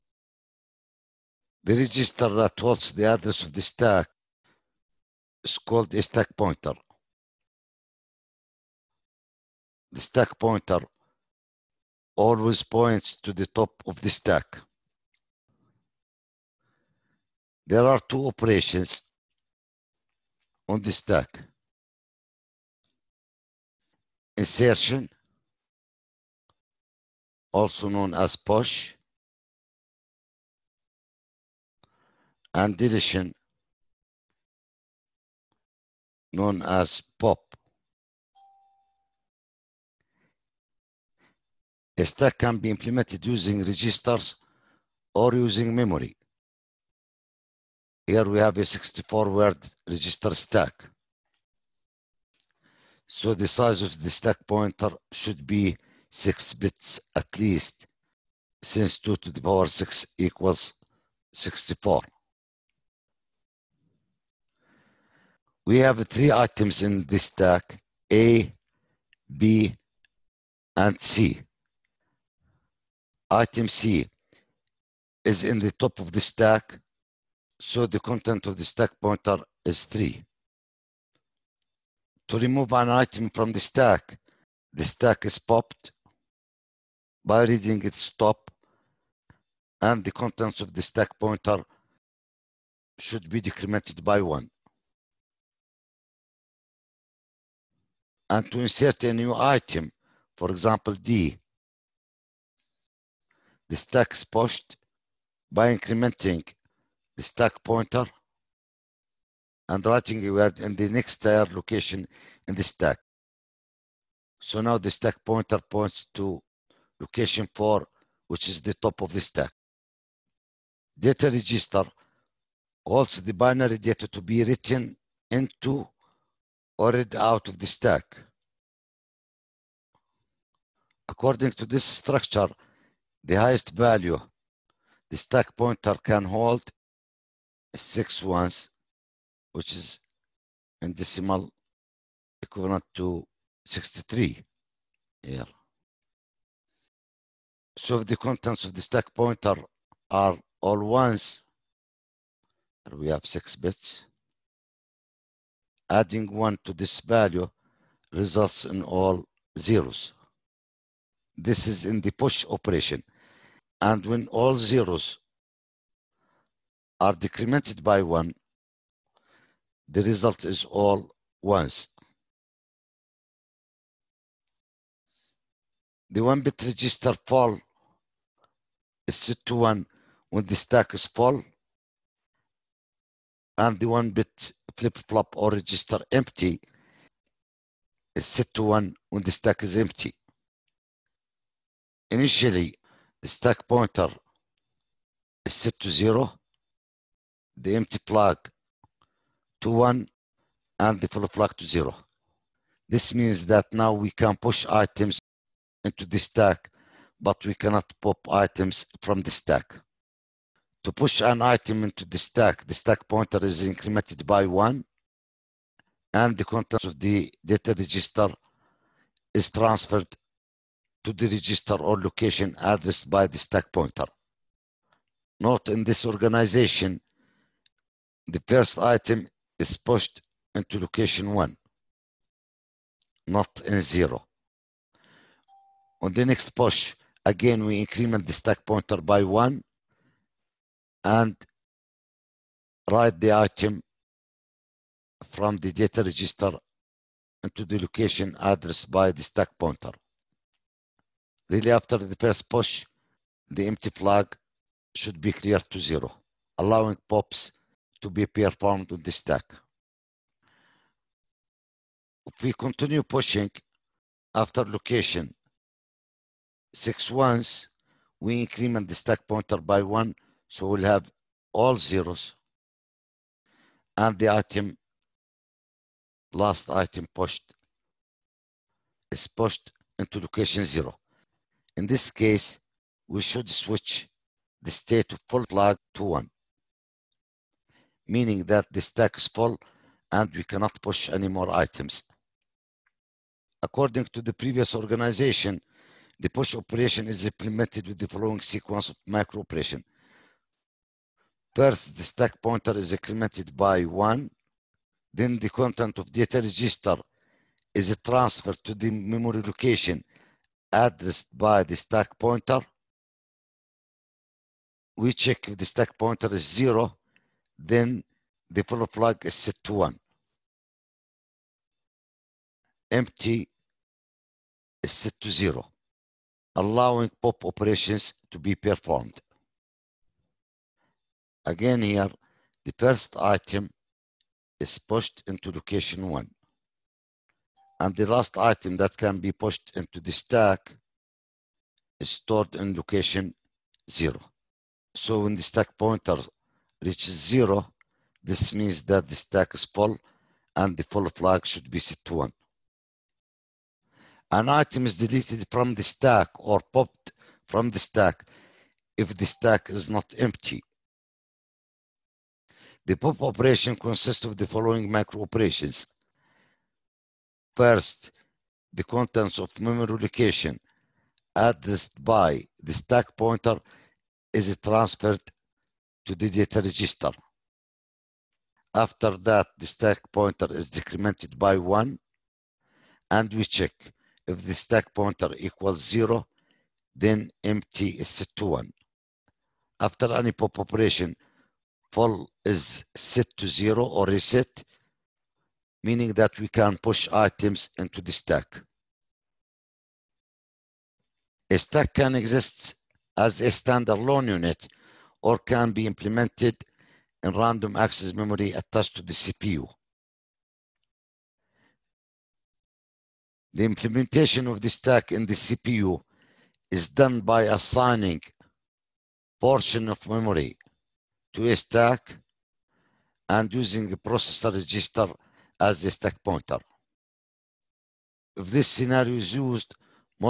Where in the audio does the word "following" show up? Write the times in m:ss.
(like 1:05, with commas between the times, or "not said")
4:58, 6:04.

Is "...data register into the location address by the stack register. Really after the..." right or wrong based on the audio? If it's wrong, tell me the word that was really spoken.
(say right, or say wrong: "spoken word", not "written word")
wrong: "pointer", not "register".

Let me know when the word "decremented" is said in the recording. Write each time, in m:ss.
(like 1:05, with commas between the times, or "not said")
1:33, 2:47, 6:20.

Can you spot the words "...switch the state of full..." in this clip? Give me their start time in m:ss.
4:43.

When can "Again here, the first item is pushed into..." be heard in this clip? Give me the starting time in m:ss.
5:31.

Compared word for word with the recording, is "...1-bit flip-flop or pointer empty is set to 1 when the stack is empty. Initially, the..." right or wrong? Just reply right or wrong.
wrong.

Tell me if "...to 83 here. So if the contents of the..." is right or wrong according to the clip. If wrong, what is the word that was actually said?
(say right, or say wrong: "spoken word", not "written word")
wrong: "63", not "83".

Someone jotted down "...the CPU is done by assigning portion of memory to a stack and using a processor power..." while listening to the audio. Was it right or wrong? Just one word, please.
wrong.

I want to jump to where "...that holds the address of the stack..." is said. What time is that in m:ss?
0:02.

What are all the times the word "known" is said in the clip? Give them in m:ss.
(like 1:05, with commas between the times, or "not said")
0:27, 0:36.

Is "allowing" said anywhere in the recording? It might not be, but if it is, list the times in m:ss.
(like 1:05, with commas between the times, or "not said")
4:16, 5:26.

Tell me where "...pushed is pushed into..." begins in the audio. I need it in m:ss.
4:37.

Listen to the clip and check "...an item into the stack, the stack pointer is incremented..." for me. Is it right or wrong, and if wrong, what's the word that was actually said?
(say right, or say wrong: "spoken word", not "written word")
right.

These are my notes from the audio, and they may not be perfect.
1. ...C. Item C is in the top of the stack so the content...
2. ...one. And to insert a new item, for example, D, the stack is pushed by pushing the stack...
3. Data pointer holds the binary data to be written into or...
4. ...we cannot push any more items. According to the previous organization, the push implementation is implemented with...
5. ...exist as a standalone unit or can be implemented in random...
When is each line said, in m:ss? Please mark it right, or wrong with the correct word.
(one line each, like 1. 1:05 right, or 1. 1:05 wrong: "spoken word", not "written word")
1. 1:11 right
2. 1:34 wrong: "incrementing", not "pushing"
3. 2:00 wrong: "register", not "pointer"
4. 4:50 wrong: "operation", not "implementation"
5. 6:42 right.